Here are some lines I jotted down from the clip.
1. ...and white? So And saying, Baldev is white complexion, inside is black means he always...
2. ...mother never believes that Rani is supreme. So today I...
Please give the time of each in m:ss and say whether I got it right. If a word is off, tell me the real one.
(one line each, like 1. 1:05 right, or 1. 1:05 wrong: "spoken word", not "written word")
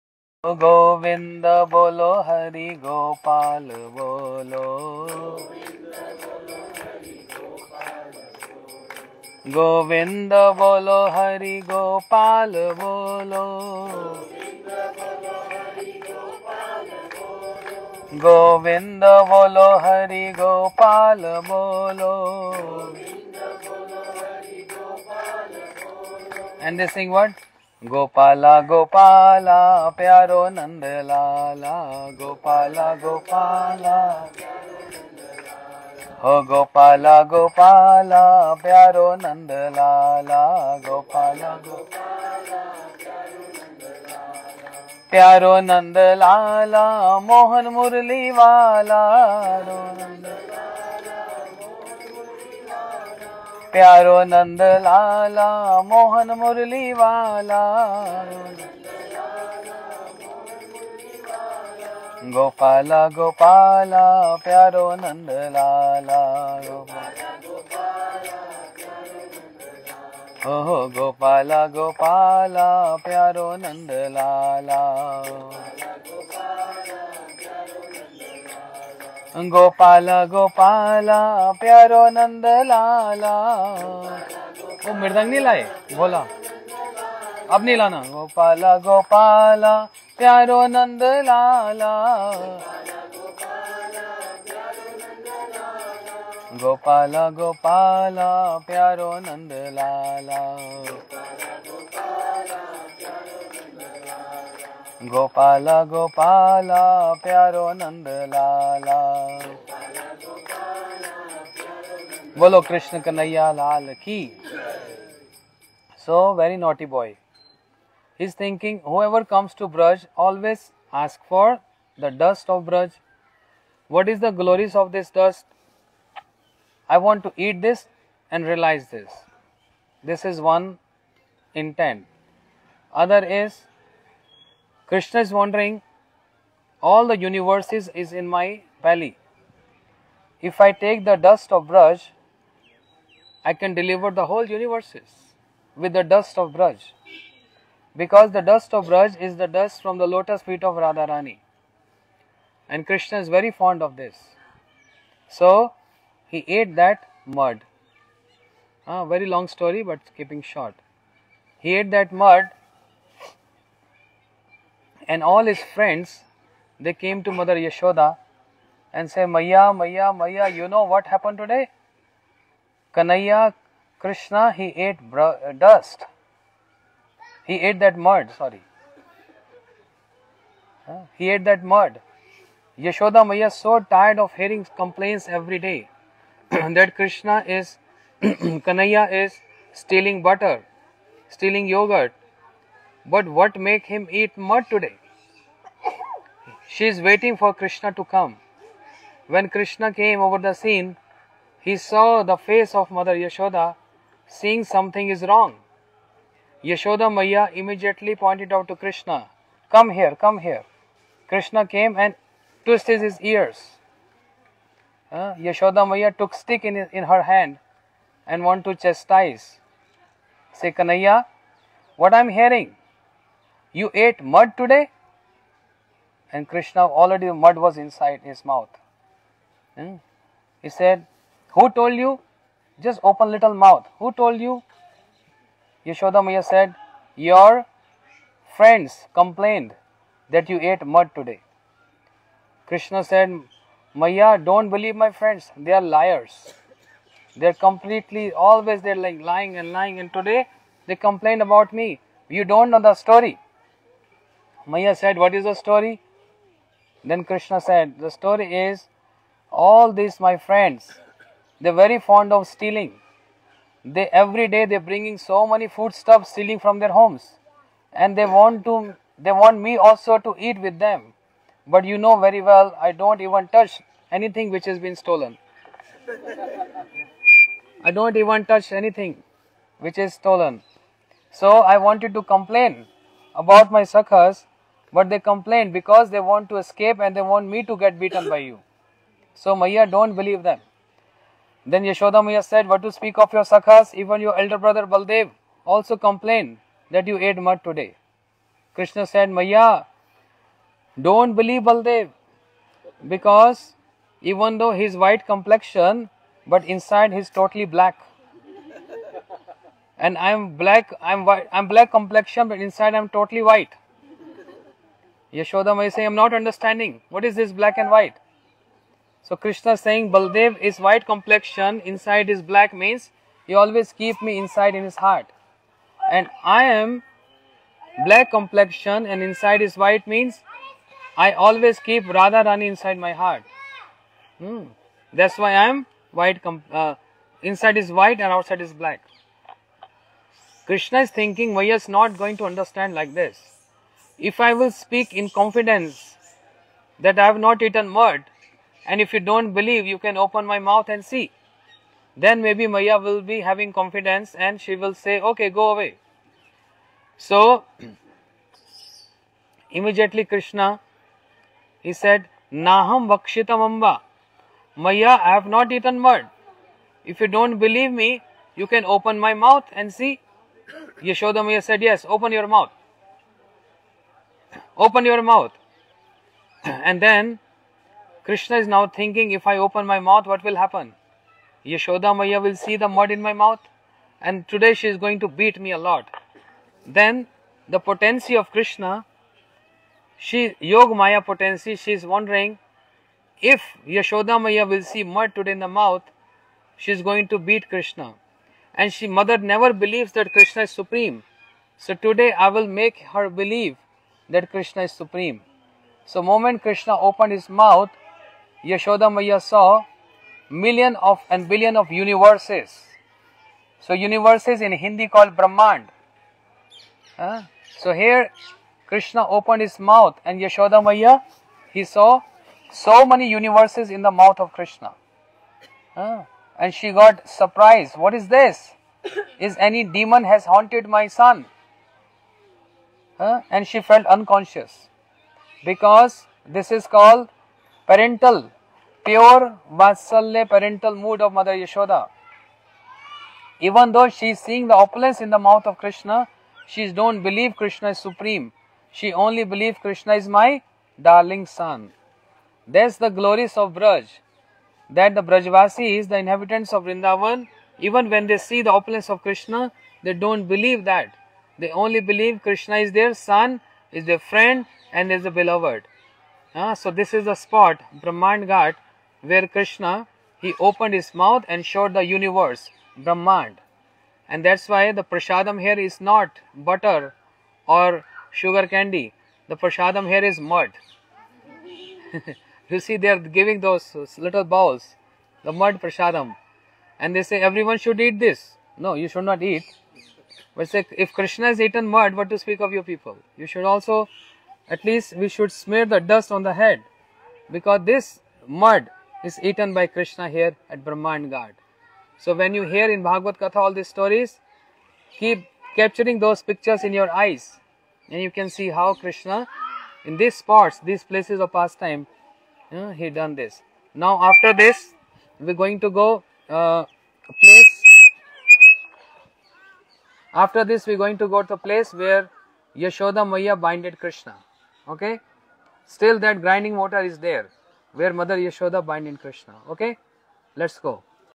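1. 5:17 wrong: "Krishna", not "And"
2. 6:39 wrong: "Krishna", not "Rani".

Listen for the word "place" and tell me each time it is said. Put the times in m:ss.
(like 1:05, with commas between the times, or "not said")
8:31, 8:37, 8:41.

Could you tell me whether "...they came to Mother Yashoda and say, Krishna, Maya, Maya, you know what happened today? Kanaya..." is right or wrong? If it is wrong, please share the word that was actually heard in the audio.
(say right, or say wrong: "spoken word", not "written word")
wrong: "Maya", not "Krishna".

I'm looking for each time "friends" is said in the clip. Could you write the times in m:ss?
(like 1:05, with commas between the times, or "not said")
2:45, 3:58, 4:05, 4:20, 7:44.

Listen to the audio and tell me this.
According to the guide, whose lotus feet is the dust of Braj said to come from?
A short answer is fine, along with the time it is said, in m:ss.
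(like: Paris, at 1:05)
Radharani, at 2:30.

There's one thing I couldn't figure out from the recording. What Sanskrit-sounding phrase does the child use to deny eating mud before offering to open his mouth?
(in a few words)
Naham Vakshitam.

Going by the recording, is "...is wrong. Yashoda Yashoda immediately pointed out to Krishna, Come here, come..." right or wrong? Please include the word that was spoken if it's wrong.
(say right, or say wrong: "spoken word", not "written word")
wrong: "Maya", not "Yashoda".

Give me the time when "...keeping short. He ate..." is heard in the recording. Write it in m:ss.
2:40.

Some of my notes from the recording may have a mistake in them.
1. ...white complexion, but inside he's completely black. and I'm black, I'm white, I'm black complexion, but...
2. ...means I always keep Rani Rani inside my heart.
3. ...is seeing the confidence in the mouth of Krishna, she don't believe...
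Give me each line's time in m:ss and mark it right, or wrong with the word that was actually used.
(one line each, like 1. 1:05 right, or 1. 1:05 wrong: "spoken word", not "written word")
1. 5:04 wrong: "totally", not "completely"
2. 5:30 wrong: "Radha", not "Rani"
3. 7:24 wrong: "opulence", not "confidence".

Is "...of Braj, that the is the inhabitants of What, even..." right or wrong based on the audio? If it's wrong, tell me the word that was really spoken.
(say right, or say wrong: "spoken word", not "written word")
wrong: "Vrindavan", not "What".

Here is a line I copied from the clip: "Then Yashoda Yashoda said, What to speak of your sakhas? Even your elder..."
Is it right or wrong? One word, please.
wrong.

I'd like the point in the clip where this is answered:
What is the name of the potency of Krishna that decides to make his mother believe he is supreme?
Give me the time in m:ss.
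6:30.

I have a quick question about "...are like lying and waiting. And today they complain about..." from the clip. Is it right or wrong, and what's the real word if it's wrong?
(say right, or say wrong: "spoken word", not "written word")
wrong: "lying", not "waiting".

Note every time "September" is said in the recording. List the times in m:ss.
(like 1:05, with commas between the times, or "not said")
not said.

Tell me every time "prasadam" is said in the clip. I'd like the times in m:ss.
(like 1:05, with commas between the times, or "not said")
7:55, 7:59, 8:05.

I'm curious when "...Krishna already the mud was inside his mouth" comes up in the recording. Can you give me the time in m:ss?
3:46.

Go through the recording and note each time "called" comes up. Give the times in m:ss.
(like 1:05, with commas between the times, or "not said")
6:55, 7:16.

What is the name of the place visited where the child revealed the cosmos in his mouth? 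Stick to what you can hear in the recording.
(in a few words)
Brahmand Ghat.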